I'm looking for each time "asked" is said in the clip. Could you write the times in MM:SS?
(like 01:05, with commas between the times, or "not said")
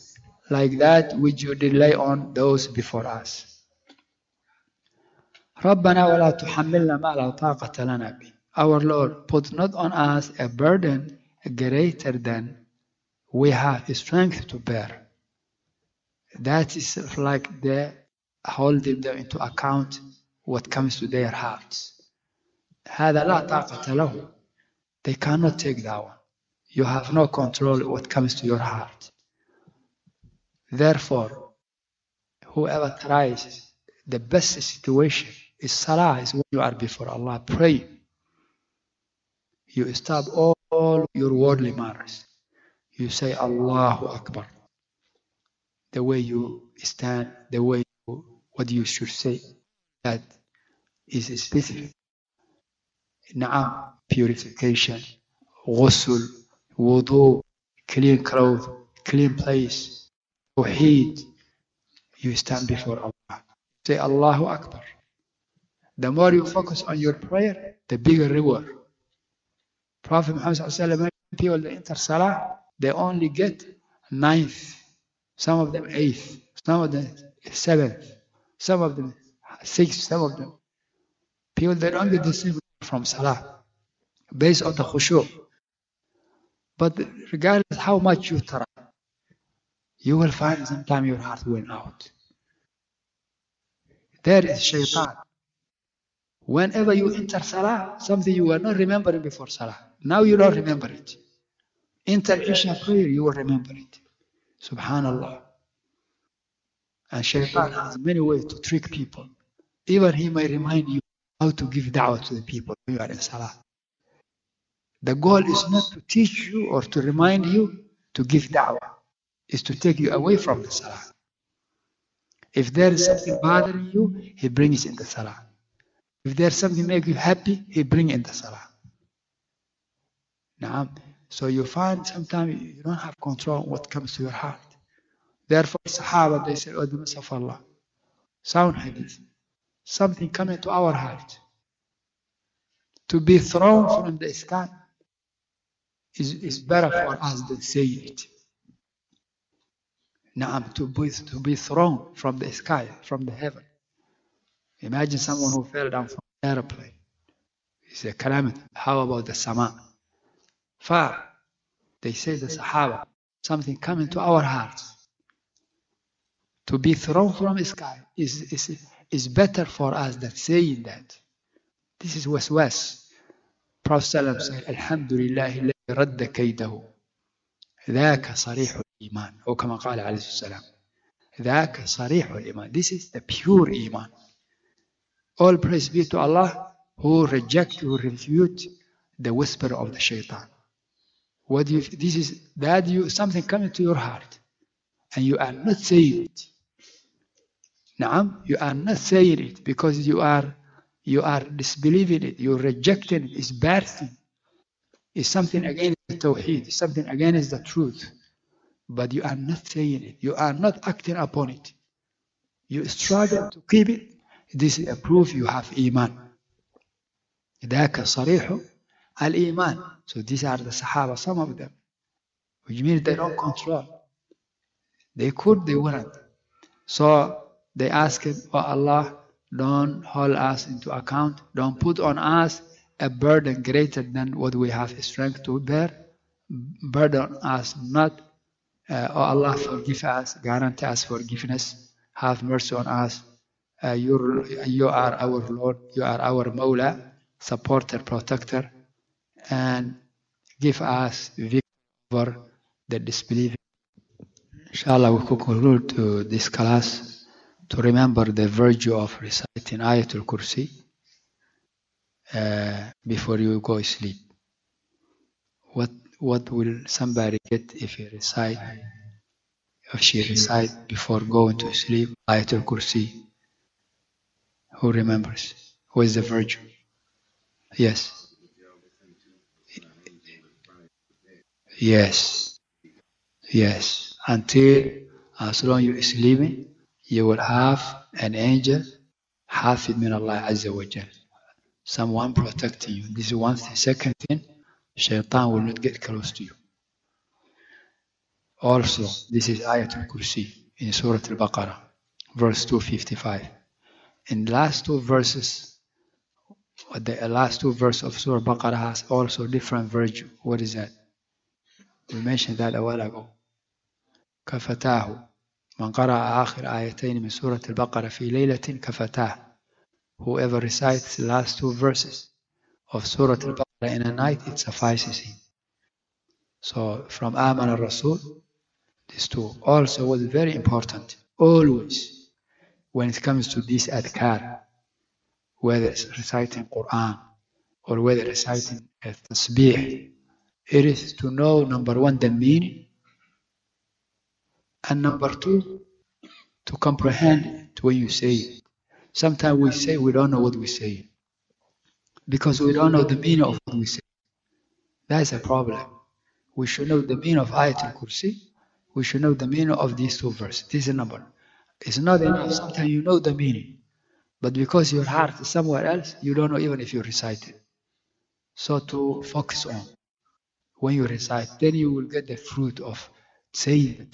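03:47.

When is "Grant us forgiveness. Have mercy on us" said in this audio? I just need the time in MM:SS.
04:00.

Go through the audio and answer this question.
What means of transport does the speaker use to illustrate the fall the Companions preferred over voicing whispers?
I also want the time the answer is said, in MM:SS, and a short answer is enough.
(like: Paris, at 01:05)
airplane, at 02:36.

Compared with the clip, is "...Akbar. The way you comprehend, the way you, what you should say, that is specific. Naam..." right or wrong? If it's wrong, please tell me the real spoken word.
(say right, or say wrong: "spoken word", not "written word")
wrong: "stand", not "comprehend".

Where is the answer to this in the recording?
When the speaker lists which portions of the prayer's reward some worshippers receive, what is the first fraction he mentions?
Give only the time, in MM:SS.
01:14.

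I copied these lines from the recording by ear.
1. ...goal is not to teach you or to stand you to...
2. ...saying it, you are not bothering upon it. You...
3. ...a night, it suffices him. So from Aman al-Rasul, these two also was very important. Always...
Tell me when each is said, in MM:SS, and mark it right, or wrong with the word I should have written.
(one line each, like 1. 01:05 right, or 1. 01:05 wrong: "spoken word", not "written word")
1. 01:55 wrong: "remind", not "stand"
2. 03:29 wrong: "acting", not "bothering"
3. 05:24 right.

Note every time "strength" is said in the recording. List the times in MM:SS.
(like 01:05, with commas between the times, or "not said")
00:13, 03:55.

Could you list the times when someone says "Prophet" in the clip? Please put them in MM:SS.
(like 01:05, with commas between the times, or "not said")
01:10, 02:53.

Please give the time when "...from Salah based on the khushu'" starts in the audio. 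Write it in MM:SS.
01:22.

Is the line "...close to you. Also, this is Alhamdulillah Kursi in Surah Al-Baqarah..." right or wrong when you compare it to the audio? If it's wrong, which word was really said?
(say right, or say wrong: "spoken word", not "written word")
wrong: "Ayatul", not "Alhamdulillah".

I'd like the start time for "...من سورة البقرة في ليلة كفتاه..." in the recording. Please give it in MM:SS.
05:17.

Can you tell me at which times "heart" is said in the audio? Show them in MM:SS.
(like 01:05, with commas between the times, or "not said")
00:21, 00:28, 01:31, 02:14, 02:20, 02:44, 03:13, 06:05.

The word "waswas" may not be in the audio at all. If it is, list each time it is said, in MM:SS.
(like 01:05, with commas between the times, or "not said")
02:52.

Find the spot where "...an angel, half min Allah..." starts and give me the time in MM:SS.
04:48.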